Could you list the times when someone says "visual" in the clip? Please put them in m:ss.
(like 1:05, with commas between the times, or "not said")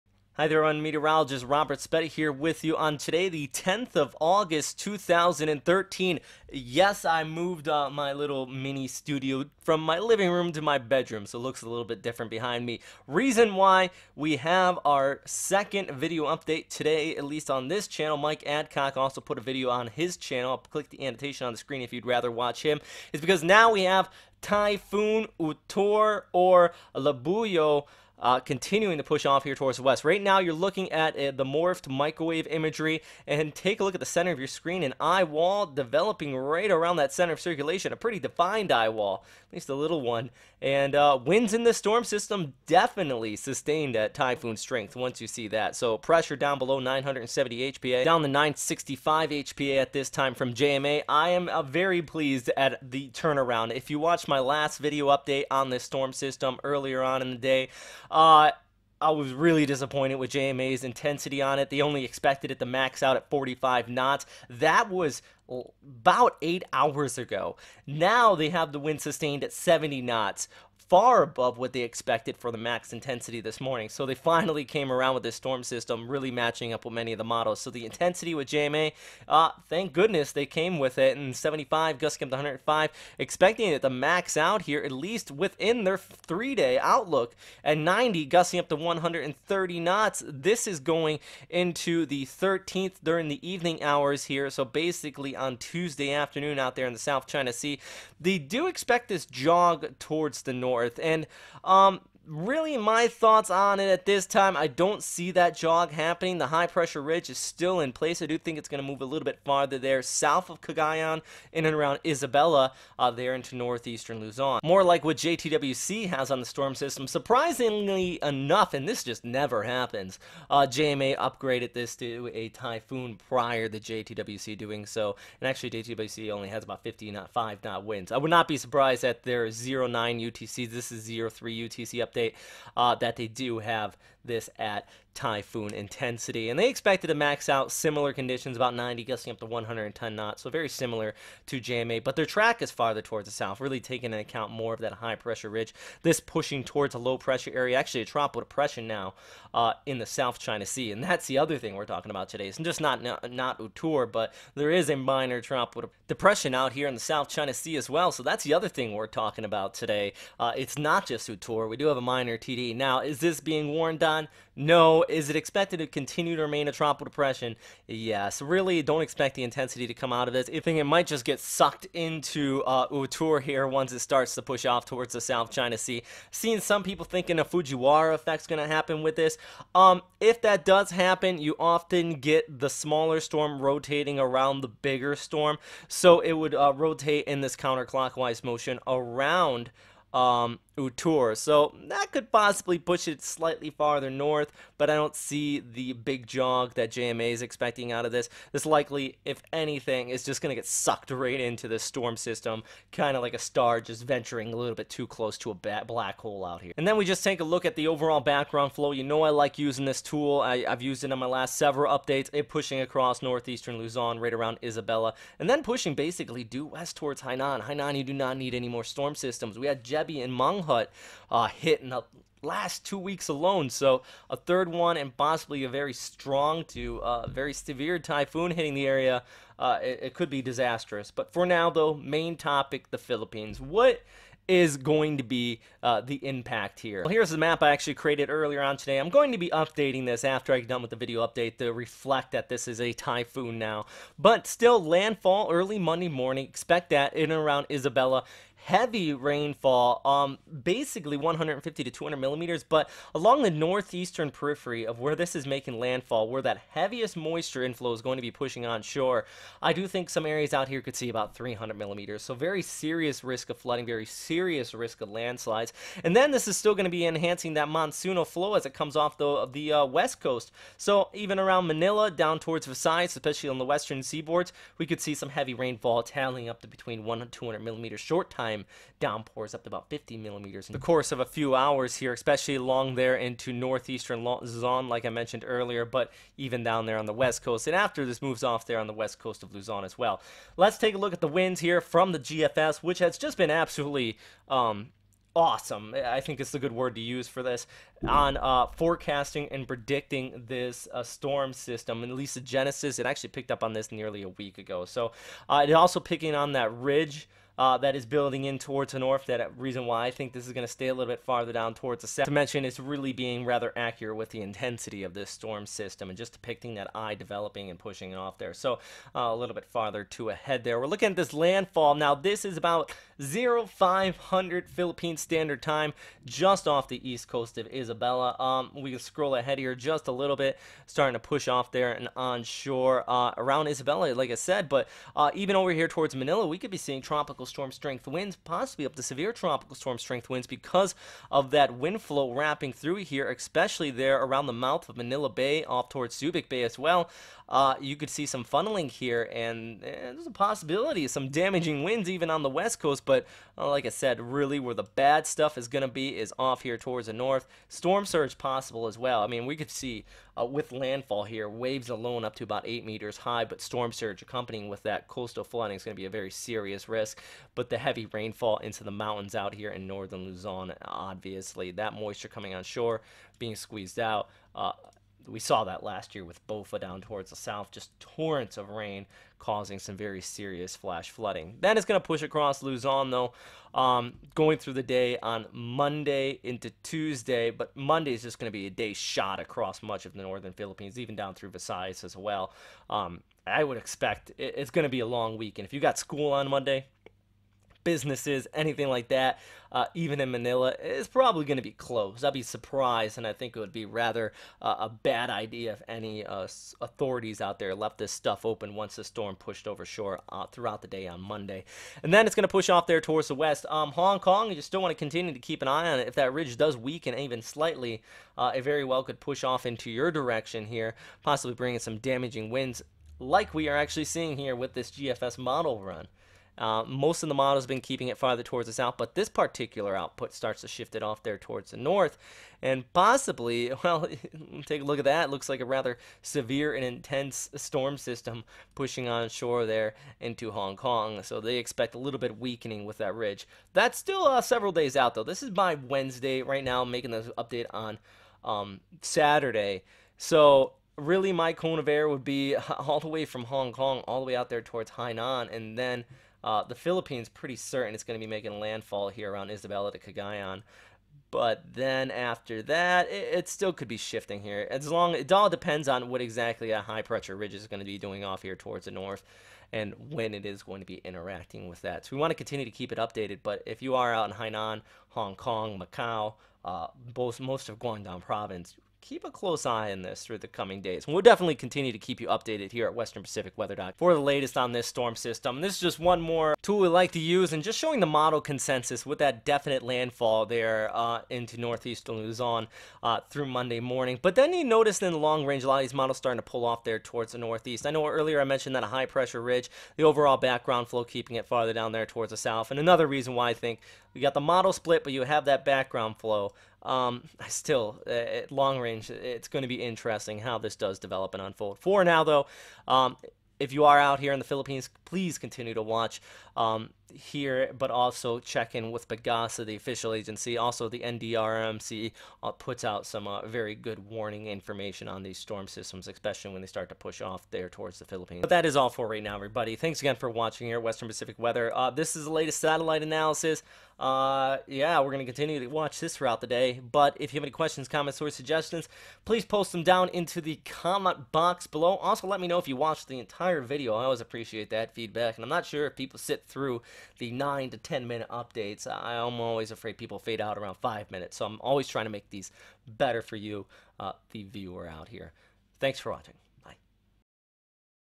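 not said.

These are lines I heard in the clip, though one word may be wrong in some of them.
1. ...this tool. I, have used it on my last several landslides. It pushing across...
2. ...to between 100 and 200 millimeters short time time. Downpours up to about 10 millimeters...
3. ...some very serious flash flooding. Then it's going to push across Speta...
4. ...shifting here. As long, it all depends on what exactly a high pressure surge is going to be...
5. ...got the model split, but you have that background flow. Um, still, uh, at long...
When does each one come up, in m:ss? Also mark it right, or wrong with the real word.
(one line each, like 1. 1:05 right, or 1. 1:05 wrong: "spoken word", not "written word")
1. 3:29 wrong: "updates", not "landslides"
2. 4:36 wrong: "50", not "10"
3. 6:19 wrong: "Luzon", not "Speta"
4. 7:43 wrong: "ridge", not "surge"
5. 8:24 right.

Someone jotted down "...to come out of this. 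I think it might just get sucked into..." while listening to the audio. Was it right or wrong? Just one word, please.
right.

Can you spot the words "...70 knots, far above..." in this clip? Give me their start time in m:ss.
1:09.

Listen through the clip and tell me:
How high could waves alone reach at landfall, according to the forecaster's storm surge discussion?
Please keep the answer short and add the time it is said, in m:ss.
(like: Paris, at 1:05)
8 meters, at 6:02.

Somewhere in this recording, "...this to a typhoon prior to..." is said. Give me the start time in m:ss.
2:01.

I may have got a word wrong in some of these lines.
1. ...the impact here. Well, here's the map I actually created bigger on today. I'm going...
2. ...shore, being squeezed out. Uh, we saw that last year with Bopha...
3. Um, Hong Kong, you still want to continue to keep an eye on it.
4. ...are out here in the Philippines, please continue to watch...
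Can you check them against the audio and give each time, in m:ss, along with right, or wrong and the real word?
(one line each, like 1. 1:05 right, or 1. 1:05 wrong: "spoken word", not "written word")
1. 3:56 wrong: "earlier", not "bigger"
2. 6:12 right
3. 6:53 right
4. 8:33 right.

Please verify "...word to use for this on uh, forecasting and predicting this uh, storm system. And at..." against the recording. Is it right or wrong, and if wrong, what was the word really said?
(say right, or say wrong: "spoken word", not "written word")
right.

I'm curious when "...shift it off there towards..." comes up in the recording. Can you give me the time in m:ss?
7:10.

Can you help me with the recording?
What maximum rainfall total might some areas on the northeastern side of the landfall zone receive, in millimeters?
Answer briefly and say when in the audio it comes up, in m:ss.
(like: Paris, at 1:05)
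300, at 4:21.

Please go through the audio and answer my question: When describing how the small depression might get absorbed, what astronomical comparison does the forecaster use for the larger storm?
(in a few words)
a black hole.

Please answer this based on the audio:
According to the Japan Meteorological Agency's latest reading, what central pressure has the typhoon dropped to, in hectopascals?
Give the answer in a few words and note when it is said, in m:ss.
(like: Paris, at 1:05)
965, at 0:48.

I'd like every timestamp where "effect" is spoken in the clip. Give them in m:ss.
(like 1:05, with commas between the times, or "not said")
2:58.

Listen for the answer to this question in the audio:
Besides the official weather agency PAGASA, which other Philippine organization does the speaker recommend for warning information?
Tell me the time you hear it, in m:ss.
8:40.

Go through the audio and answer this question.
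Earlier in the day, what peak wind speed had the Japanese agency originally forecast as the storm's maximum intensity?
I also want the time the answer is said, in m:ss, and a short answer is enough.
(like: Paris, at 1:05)
45 knots, at 1:03.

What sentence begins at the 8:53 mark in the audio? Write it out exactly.
Uh, yeah, we're going to continue to watch this throughout the day.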